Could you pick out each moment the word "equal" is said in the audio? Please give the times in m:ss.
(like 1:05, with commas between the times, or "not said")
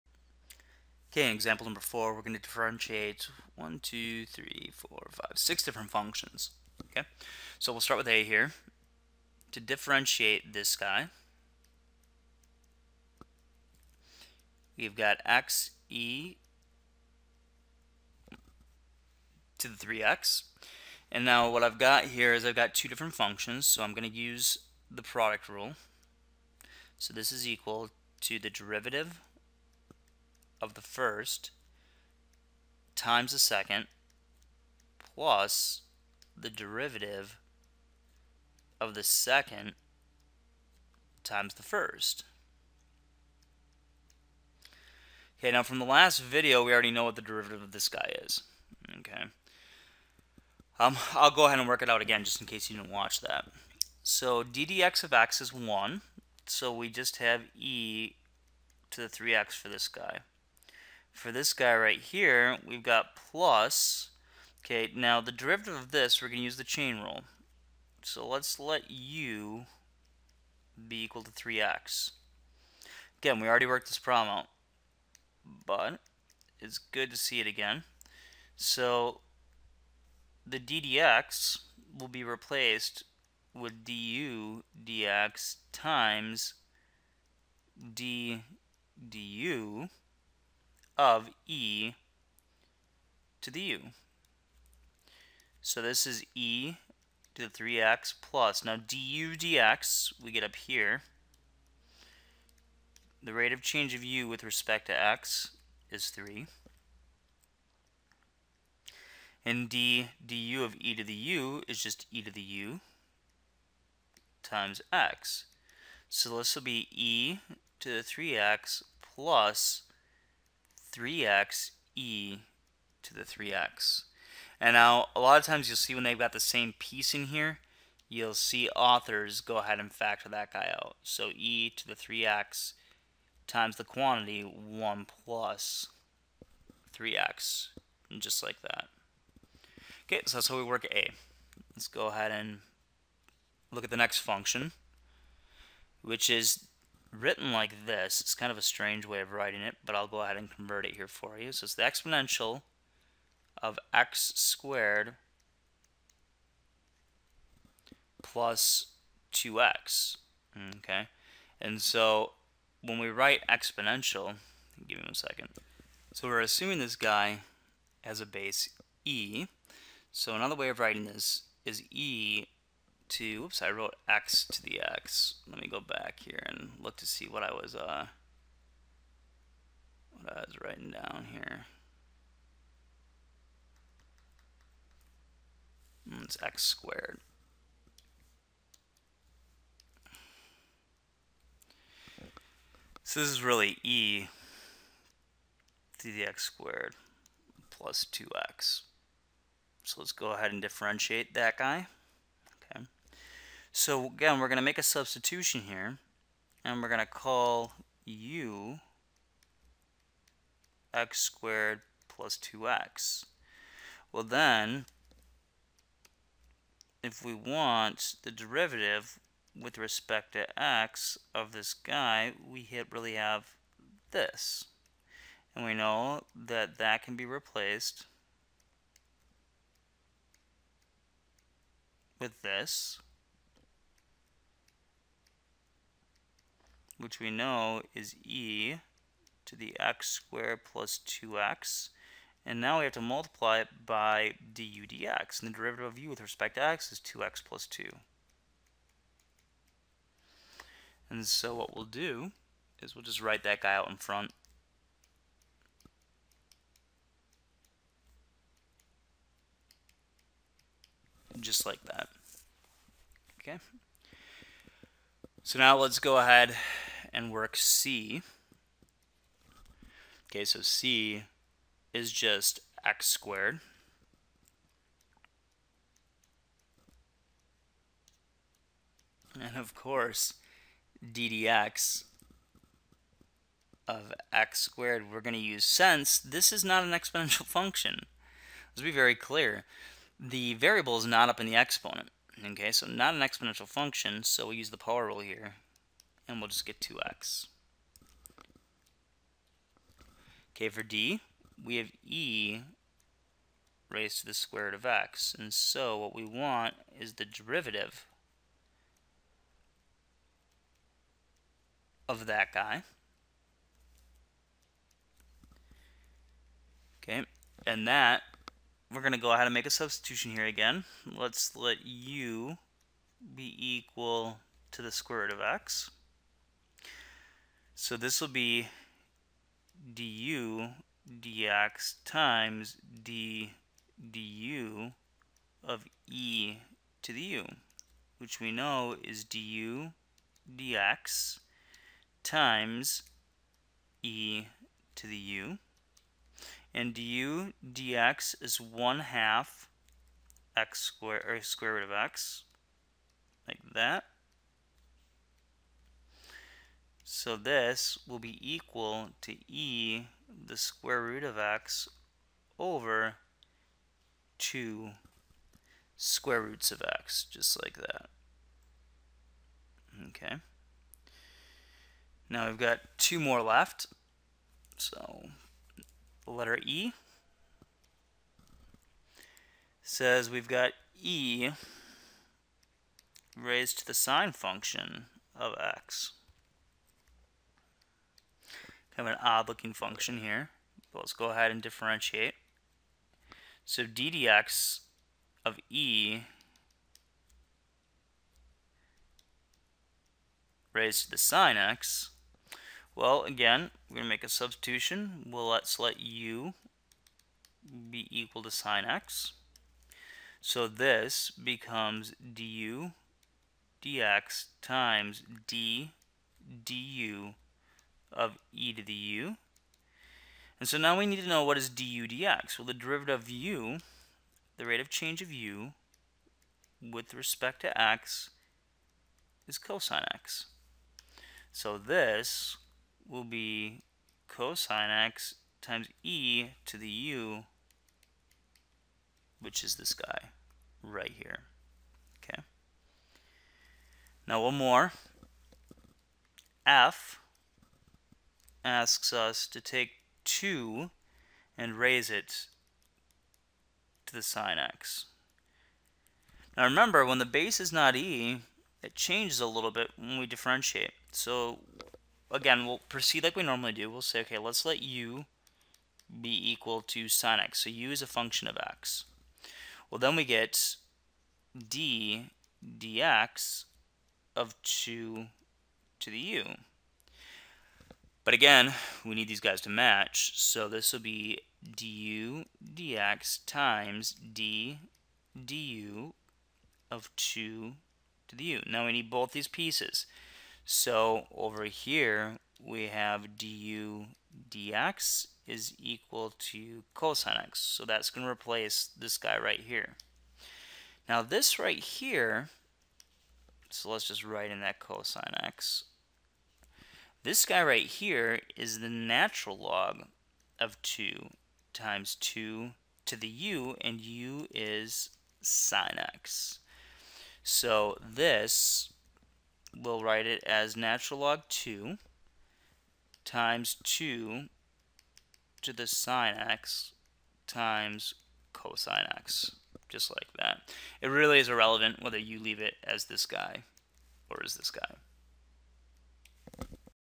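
0:27, 1:11, 5:23, 5:58, 6:48, 7:46, 8:15.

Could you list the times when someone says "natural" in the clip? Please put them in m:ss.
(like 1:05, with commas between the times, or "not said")
8:28, 8:40.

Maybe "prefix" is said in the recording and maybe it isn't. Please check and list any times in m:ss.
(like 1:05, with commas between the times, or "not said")
not said.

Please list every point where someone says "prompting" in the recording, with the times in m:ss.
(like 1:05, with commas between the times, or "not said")
not said.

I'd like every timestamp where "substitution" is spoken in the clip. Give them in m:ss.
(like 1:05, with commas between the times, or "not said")
3:24, 5:19, 6:44.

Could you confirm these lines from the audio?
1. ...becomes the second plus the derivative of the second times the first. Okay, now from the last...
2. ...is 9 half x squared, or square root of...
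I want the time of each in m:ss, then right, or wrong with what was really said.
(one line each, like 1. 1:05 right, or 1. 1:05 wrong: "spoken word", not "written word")
1. 0:32 wrong: "times", not "becomes"
2. 5:48 wrong: "1", not "9".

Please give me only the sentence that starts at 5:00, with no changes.
Okay, for d, we have e raised to the square root of x.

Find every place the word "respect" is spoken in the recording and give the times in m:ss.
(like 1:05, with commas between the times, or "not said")
1:44, 3:39, 4:06, 7:07.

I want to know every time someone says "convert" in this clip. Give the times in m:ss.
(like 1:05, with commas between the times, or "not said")
2:30.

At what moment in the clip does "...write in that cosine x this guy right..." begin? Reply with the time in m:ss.
8:24.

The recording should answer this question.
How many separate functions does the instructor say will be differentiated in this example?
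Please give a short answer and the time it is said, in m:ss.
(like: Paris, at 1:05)
6, at 0:05.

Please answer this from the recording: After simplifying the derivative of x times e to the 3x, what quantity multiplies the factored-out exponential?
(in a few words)
1 plus 3x.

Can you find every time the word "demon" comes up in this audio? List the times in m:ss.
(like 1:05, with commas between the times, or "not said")
not said.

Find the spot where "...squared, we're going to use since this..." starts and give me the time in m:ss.
4:44.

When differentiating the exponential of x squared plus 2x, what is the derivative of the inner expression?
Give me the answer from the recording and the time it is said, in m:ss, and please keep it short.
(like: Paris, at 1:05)
2x plus 2, at 4:06.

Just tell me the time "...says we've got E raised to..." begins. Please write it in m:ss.
6:19.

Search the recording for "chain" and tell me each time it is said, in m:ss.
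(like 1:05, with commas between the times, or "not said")
1:06.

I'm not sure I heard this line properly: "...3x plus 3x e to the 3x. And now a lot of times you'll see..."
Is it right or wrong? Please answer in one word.
right.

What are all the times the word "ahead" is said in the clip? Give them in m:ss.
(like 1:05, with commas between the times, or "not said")
0:51, 2:09, 2:22, 2:30, 3:20, 4:26, 5:19, 6:31.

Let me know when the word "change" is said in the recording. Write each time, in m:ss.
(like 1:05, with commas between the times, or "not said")
1:43, 7:04, 7:38.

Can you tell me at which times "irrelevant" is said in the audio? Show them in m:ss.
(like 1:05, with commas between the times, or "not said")
8:51.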